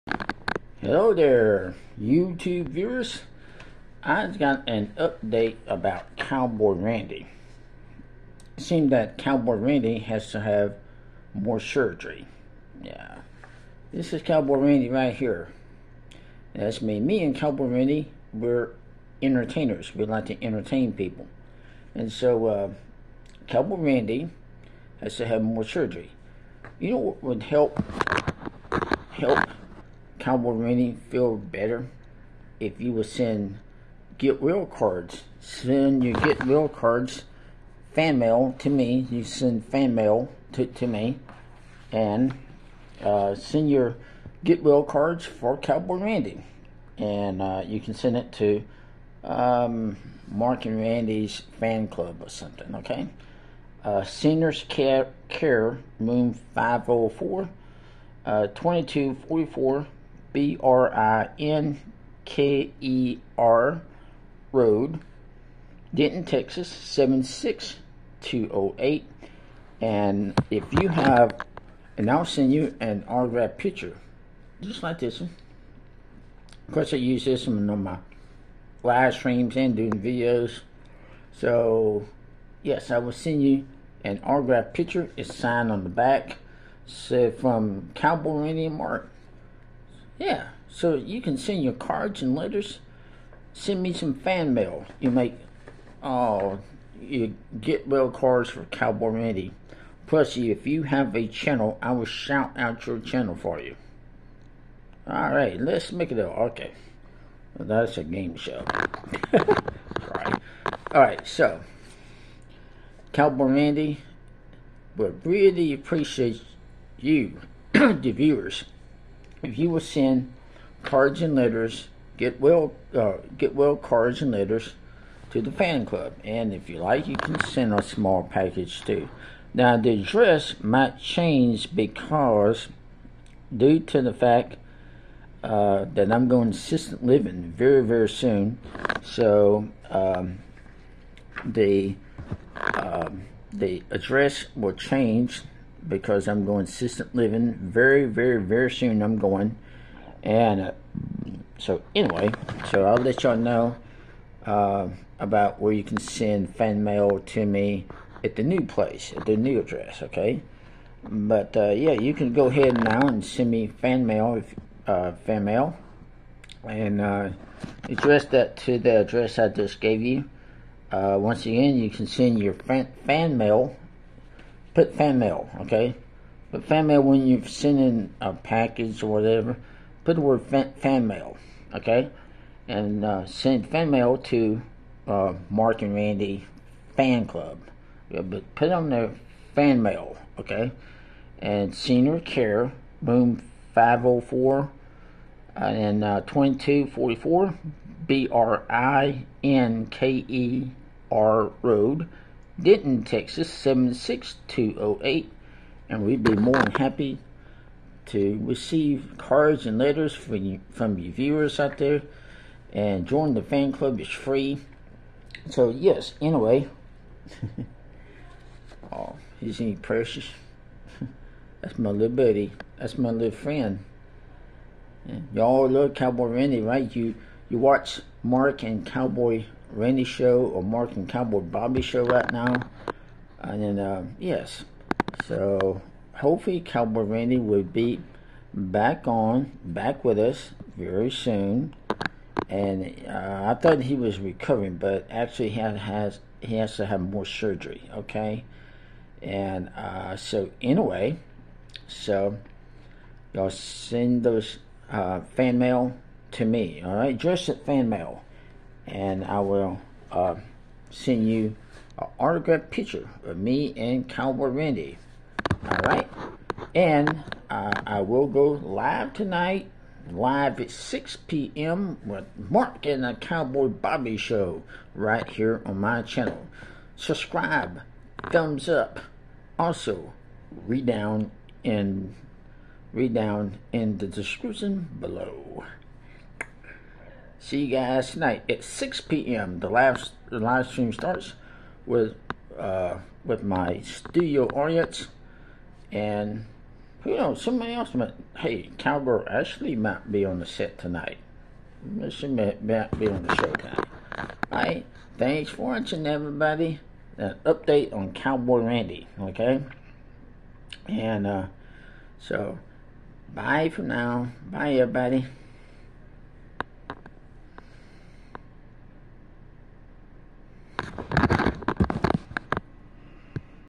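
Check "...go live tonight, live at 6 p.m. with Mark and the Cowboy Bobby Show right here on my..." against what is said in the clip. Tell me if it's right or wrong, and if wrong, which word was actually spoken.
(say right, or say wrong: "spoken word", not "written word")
right.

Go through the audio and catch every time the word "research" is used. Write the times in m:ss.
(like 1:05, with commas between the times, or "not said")
not said.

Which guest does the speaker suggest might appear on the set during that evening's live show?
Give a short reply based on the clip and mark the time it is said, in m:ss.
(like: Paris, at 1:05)
Cowgirl Ashley, at 4:58.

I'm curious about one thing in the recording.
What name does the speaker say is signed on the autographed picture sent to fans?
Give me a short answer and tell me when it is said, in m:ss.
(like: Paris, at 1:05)
Cowboy Indian Mark, at 1:27.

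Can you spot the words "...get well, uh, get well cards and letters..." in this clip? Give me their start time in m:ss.
2:02.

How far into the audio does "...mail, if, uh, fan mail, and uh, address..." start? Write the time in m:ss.
2:44.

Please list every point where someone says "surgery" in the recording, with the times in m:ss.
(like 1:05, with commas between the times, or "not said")
0:11, 0:25, 4:07.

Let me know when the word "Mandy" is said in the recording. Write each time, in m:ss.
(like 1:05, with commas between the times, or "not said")
1:39, 1:53.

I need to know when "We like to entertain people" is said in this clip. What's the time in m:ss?
0:19.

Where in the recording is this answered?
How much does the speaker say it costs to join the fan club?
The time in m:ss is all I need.
3:34.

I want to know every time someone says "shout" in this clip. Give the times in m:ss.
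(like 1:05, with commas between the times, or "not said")
1:42.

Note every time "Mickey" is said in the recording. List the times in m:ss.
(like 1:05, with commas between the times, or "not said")
not said.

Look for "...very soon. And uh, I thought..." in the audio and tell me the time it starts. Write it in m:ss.
4:00.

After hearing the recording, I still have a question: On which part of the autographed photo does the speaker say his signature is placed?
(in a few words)
On the back.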